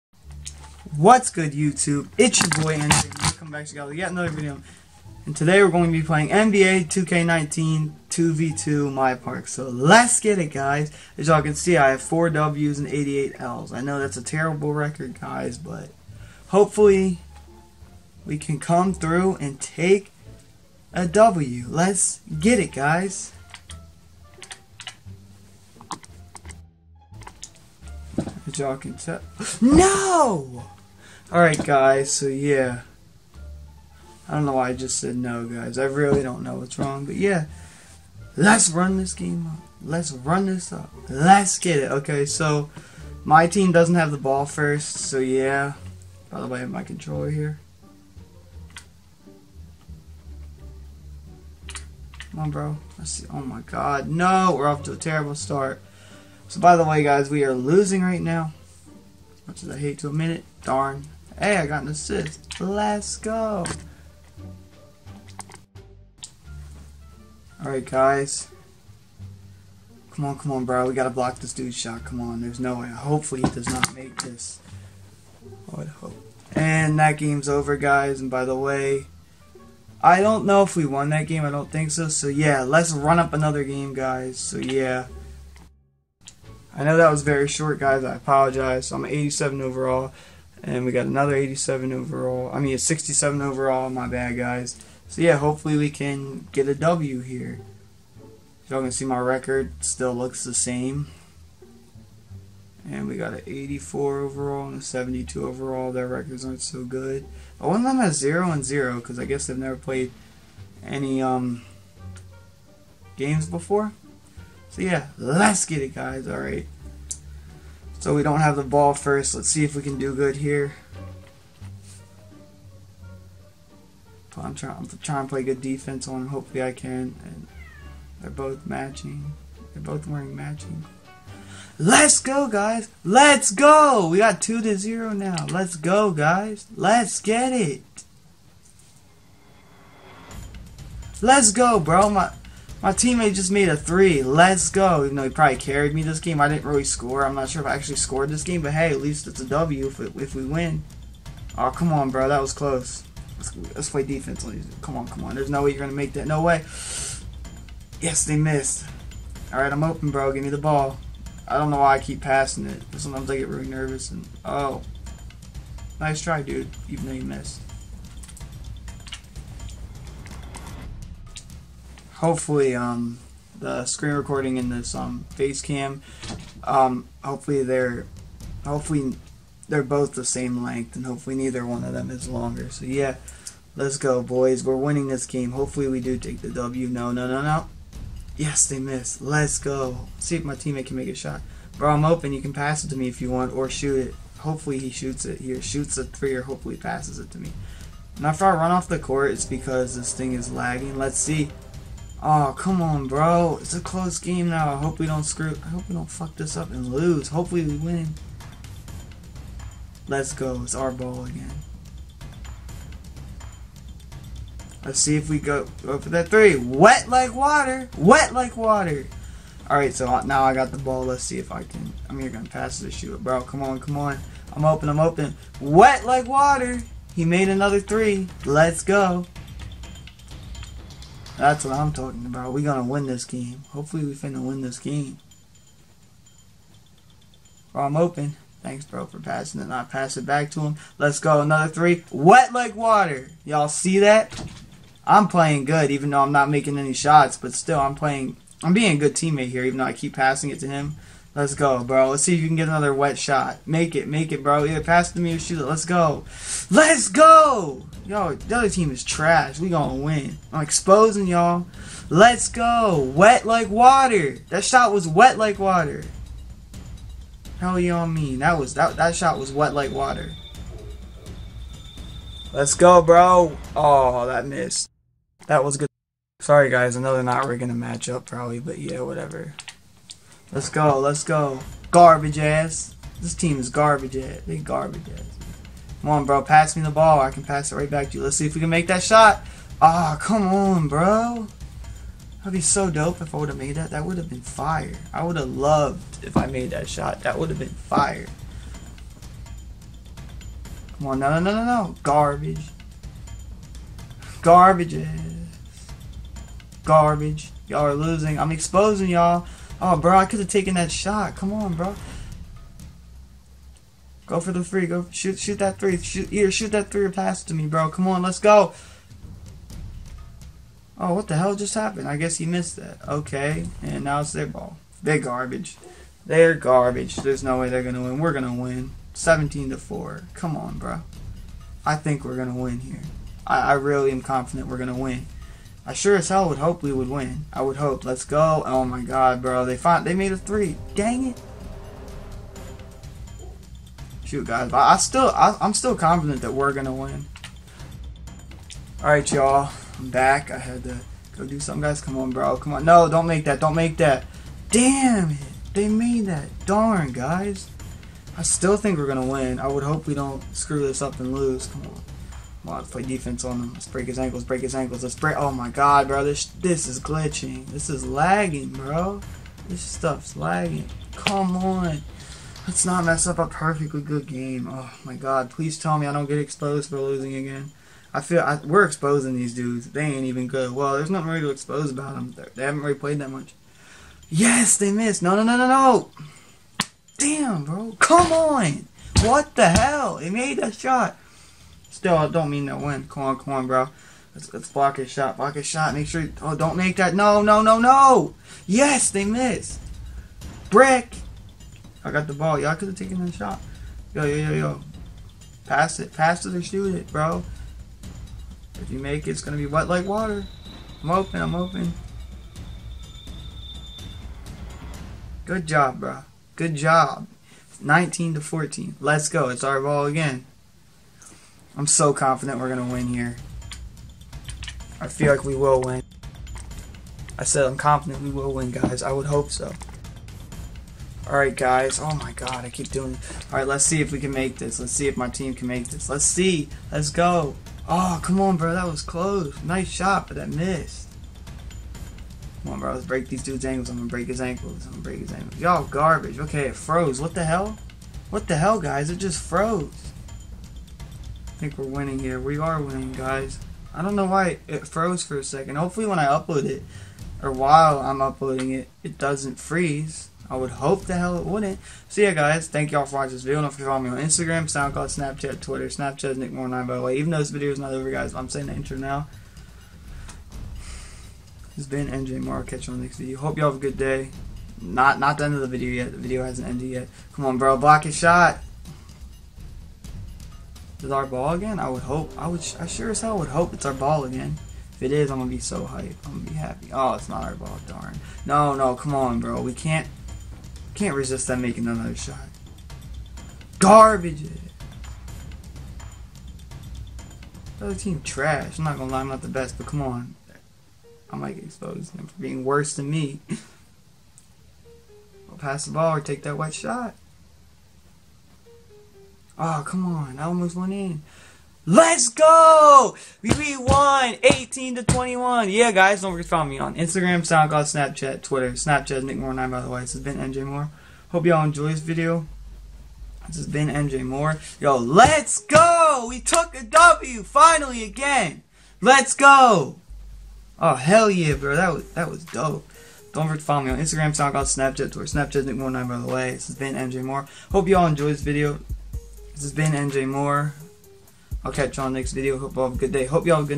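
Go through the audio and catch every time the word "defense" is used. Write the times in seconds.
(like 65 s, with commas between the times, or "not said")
125 s, 154 s, 363 s.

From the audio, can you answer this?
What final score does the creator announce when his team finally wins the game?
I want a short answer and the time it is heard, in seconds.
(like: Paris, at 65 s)
18 to 21, at 514 s.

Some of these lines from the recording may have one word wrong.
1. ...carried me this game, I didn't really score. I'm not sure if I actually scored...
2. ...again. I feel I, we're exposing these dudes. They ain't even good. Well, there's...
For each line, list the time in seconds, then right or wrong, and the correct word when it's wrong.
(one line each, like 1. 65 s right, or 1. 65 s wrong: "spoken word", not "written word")
1. 145 s right
2. 377 s right.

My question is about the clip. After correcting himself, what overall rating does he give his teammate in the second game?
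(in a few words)
67.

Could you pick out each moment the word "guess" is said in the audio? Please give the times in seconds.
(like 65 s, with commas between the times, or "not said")
109 s, 322 s.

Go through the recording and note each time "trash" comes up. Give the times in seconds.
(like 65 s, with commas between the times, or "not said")
259 s, 498 s.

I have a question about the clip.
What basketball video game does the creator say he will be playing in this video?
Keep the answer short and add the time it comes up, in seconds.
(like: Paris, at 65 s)
NBA 2K19, at 6 s.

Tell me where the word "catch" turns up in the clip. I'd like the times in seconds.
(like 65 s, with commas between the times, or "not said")
472 s, 541 s.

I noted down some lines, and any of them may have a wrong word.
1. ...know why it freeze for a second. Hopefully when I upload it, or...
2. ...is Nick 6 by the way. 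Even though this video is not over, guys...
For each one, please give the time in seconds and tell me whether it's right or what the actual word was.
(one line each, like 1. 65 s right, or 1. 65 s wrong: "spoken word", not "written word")
1. 454 s wrong: "froze", not "freeze"
2. 466 s wrong: "9", not "6".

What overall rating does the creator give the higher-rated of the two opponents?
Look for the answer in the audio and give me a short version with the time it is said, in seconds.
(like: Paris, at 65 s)
84, at 103 s.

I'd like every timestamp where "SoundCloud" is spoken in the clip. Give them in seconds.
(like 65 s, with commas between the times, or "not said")
464 s, 517 s, 534 s.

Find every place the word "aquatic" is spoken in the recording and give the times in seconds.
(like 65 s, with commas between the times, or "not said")
not said.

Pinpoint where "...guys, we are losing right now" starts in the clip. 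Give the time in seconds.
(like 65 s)
57 s.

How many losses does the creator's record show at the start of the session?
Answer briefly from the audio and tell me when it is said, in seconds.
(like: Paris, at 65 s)
88, at 12 s.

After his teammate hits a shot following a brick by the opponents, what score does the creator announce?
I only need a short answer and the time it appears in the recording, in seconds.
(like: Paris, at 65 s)
19 to 14, at 417 s.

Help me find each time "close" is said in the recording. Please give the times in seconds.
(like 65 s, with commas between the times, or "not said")
152 s, 203 s, 439 s.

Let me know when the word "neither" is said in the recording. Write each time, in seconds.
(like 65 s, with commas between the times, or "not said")
181 s.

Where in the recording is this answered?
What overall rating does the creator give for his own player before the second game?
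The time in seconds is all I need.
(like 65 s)
88 s.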